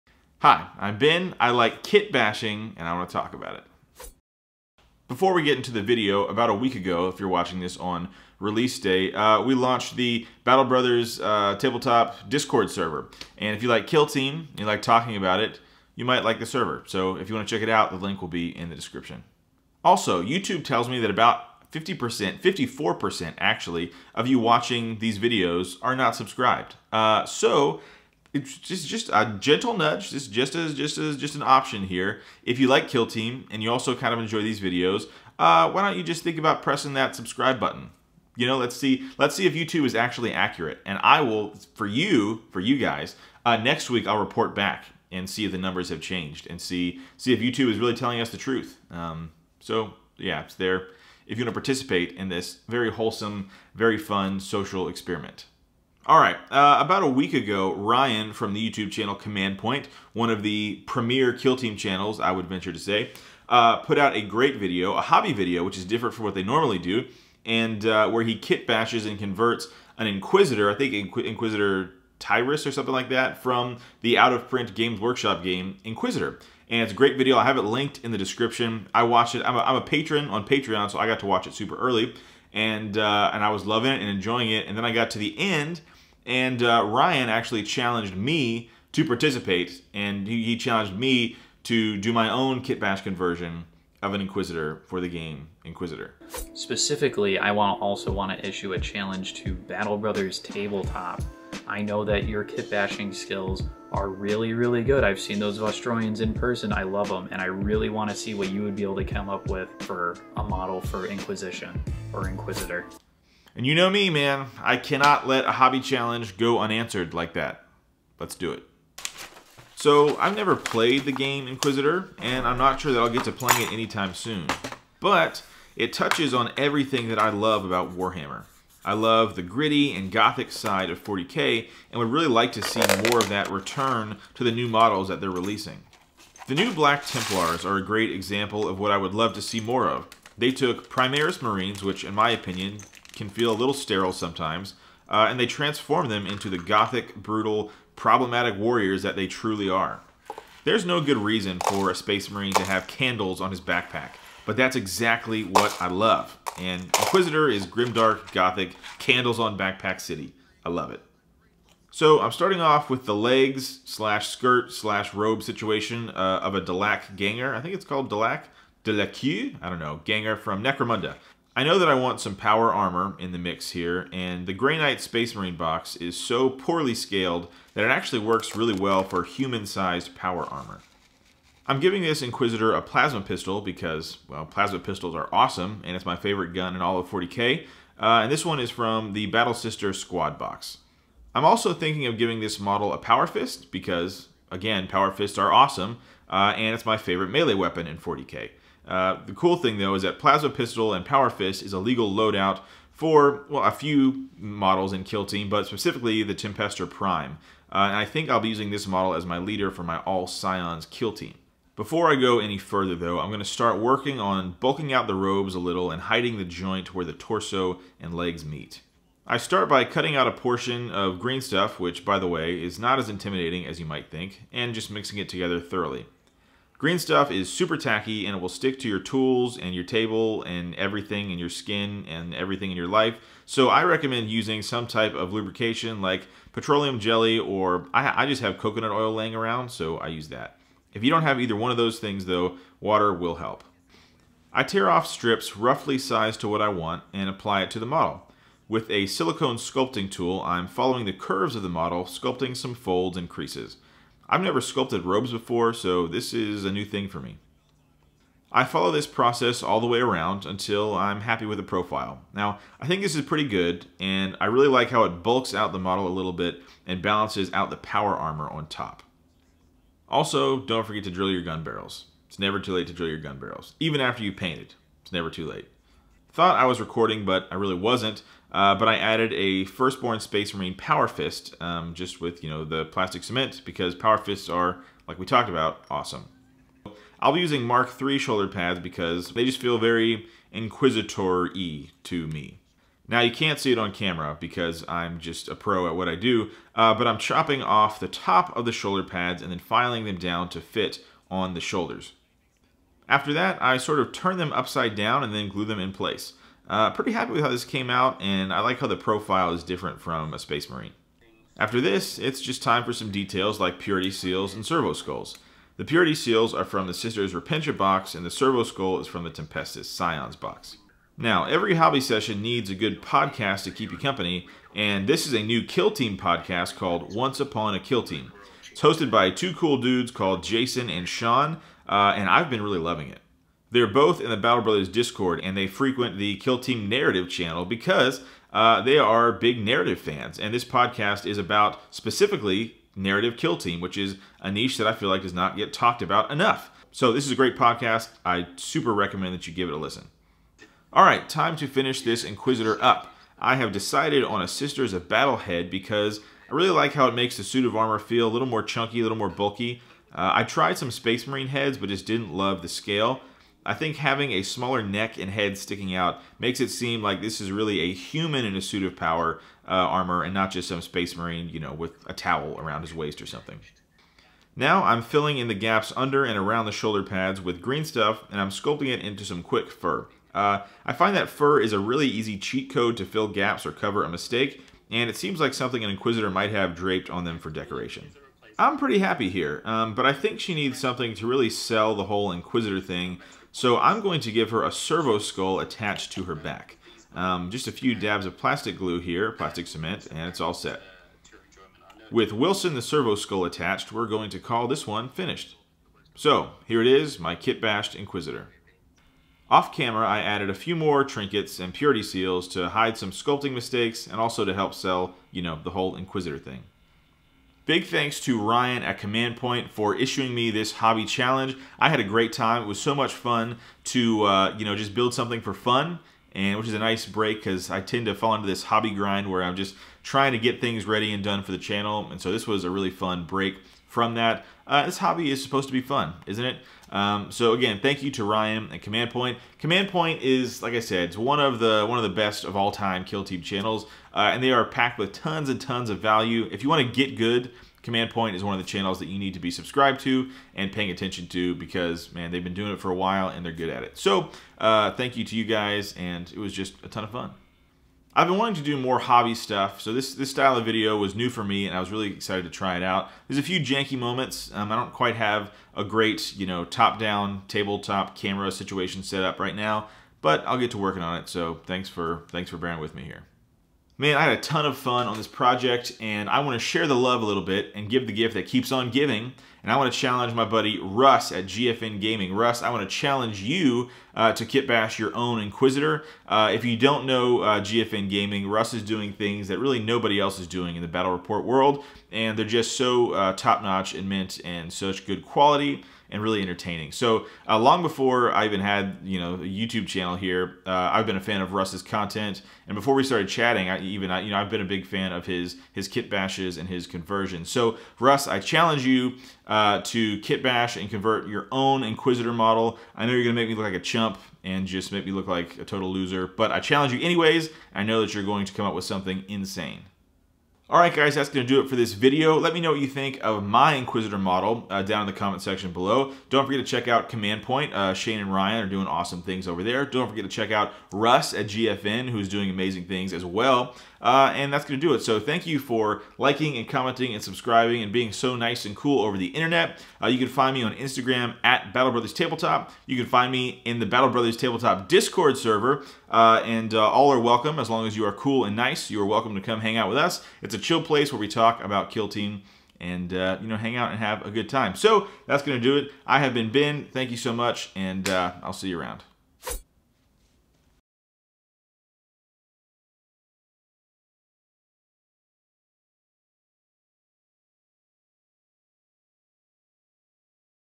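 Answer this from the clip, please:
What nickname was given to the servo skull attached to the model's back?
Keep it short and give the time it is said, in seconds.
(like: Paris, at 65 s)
Wilson, at 402 s.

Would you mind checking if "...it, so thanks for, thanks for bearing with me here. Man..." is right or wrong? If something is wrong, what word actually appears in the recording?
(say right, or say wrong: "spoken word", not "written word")
right.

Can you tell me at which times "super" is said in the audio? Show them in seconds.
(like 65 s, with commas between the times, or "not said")
81 s, 227 s, 348 s.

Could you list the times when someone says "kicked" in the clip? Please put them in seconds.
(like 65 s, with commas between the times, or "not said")
not said.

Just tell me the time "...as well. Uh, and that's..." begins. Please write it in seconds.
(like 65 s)
533 s.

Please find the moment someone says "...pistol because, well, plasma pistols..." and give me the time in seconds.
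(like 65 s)
183 s.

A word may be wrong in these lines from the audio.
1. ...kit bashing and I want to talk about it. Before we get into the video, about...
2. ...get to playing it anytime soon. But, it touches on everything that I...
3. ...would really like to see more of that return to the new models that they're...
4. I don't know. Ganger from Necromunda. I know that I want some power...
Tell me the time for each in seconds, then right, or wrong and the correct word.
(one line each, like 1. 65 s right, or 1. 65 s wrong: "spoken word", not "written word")
1. 1 s right
2. 123 s right
3. 131 s right
4. 169 s right.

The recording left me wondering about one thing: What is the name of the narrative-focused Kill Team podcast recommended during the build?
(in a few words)
Once Upon a Kill Team.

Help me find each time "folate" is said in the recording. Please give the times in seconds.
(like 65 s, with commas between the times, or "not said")
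not said.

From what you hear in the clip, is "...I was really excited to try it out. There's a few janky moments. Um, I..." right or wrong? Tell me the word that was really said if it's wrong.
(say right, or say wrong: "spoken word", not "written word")
right.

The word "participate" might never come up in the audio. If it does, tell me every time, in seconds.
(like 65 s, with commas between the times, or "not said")
51 s, 89 s.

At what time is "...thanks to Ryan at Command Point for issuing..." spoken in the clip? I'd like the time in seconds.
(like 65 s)
417 s.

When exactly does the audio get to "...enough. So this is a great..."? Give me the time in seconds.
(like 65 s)
346 s.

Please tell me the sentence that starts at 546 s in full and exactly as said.
Uh, and uh, all are welcome as long as you are cool and nice.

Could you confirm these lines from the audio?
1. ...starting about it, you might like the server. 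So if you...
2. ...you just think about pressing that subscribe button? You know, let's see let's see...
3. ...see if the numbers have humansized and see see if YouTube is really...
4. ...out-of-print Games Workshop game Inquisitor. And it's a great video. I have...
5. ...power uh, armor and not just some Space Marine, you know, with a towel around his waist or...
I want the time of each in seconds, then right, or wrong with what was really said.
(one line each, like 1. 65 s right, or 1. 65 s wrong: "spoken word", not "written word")
1. 14 s wrong: "talking", not "starting"
2. 35 s right
3. 45 s wrong: "changed", not "humansized"
4. 74 s right
5. 368 s right.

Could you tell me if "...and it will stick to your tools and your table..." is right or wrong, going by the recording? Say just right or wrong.
right.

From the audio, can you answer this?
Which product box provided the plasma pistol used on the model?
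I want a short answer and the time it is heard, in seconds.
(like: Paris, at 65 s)
Battle Sister Squad, at 189 s.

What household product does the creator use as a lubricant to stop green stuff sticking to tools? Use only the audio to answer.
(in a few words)
Coconut oil.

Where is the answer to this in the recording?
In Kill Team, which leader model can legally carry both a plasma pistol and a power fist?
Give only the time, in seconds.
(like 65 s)
206 s.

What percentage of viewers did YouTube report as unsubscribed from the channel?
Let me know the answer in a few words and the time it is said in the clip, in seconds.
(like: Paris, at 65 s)
54%, at 22 s.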